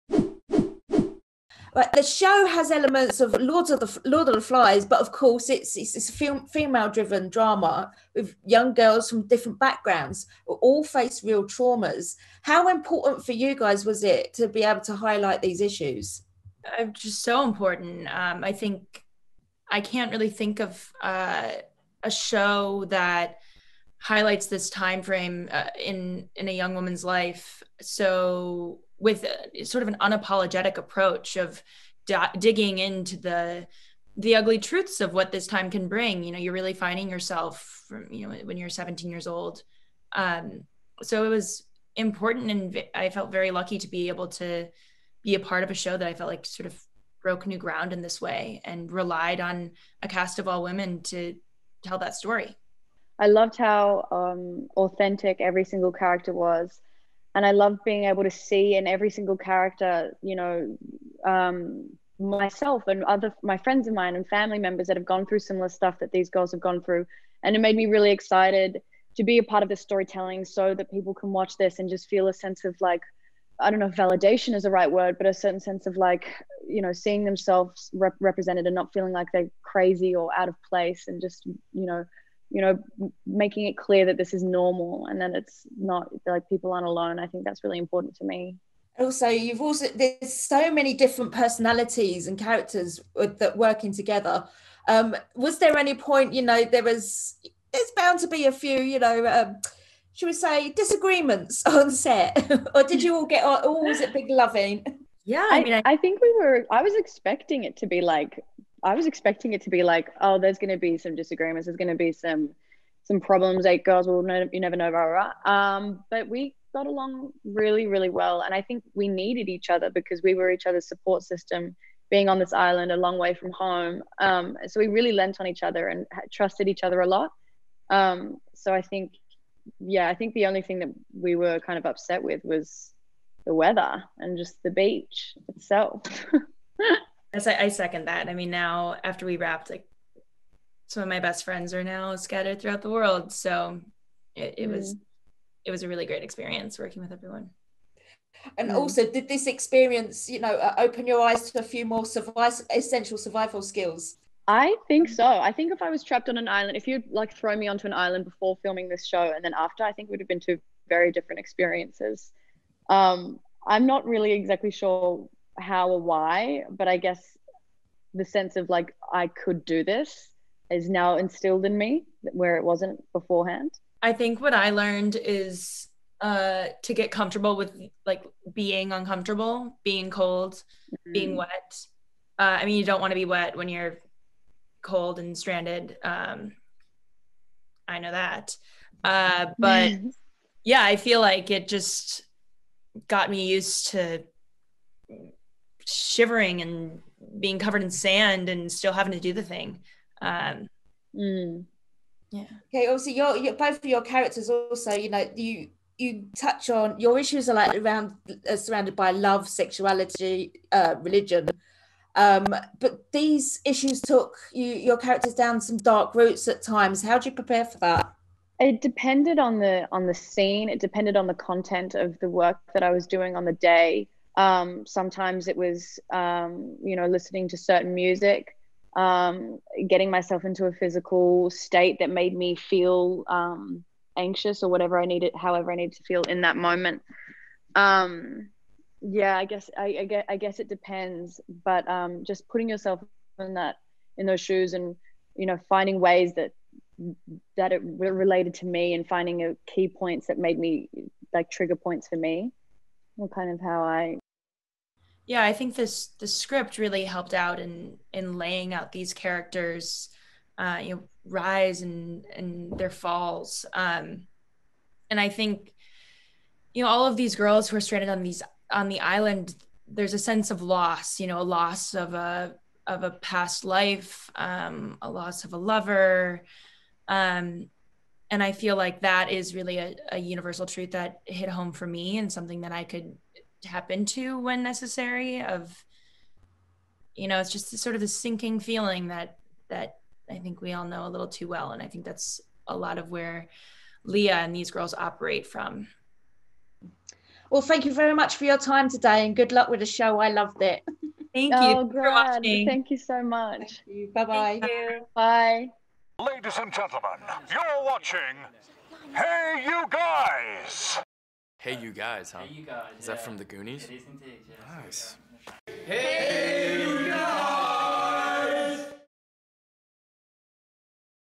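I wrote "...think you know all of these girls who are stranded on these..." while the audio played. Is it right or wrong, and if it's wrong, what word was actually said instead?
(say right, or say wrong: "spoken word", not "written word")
right.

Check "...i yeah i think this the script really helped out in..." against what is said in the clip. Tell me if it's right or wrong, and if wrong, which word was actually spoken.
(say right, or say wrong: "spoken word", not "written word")
right.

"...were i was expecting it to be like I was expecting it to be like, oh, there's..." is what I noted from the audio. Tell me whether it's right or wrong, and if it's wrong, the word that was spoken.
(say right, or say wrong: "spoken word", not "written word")
right.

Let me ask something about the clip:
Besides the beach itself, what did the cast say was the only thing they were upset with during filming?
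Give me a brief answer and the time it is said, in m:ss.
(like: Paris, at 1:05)
the weather, at 2:13.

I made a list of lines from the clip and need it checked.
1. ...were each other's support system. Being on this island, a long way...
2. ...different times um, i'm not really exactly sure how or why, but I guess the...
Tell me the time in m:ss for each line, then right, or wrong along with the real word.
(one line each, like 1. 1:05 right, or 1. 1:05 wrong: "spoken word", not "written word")
1. 2:00 right
2. 2:41 wrong: "experiences", not "times".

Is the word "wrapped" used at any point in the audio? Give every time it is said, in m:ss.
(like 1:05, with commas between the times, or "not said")
2:19.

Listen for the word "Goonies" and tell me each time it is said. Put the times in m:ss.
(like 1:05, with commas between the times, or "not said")
5:13.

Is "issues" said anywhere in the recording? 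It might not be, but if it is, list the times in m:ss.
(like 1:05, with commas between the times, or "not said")
0:15, 3:27, 3:33.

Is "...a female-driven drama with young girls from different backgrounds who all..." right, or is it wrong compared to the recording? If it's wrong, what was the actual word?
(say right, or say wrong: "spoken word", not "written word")
right.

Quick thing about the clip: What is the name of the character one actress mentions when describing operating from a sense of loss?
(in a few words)
Leah.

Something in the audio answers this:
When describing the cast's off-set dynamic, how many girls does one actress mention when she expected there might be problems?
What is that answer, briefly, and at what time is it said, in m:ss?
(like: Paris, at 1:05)
8, at 1:53.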